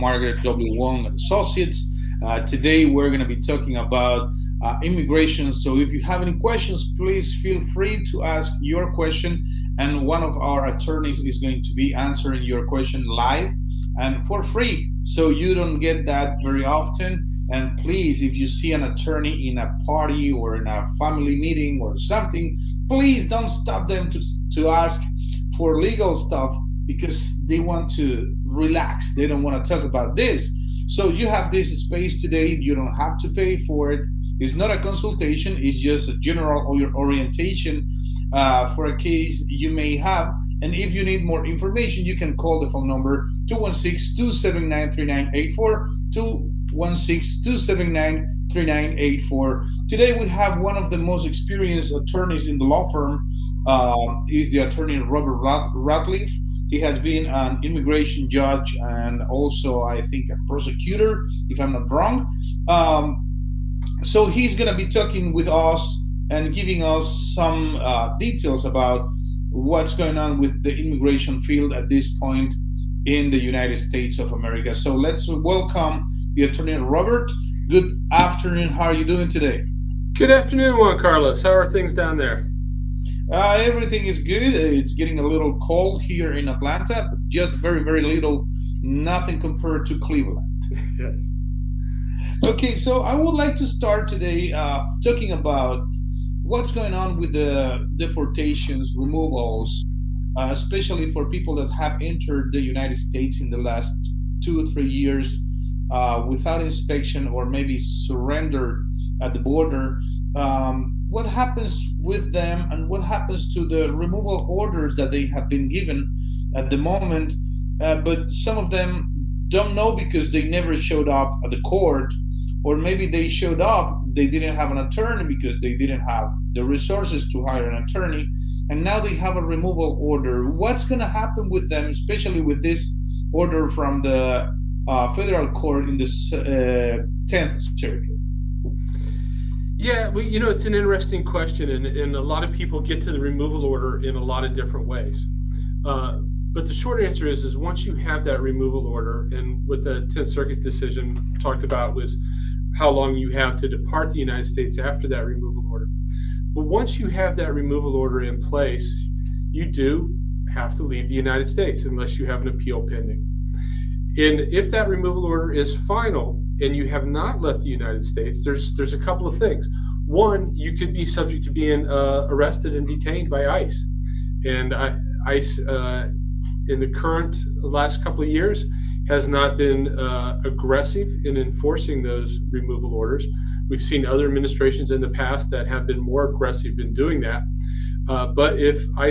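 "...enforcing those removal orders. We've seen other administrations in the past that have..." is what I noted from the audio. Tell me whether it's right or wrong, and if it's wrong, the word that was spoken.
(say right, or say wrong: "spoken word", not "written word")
right.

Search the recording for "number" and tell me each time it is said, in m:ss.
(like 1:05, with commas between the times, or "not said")
0:42.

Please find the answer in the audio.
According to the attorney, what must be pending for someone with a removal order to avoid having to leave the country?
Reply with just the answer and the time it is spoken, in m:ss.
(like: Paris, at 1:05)
An appeal, at 2:42.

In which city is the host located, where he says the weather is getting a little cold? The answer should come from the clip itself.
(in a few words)
Atlanta.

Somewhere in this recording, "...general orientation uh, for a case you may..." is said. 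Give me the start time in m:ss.
0:36.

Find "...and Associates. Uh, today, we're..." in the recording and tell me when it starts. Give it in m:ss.
0:01.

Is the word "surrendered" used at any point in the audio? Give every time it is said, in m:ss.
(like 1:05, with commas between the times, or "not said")
1:47.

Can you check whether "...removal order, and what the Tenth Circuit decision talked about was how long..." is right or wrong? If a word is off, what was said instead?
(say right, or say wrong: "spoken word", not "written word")
right.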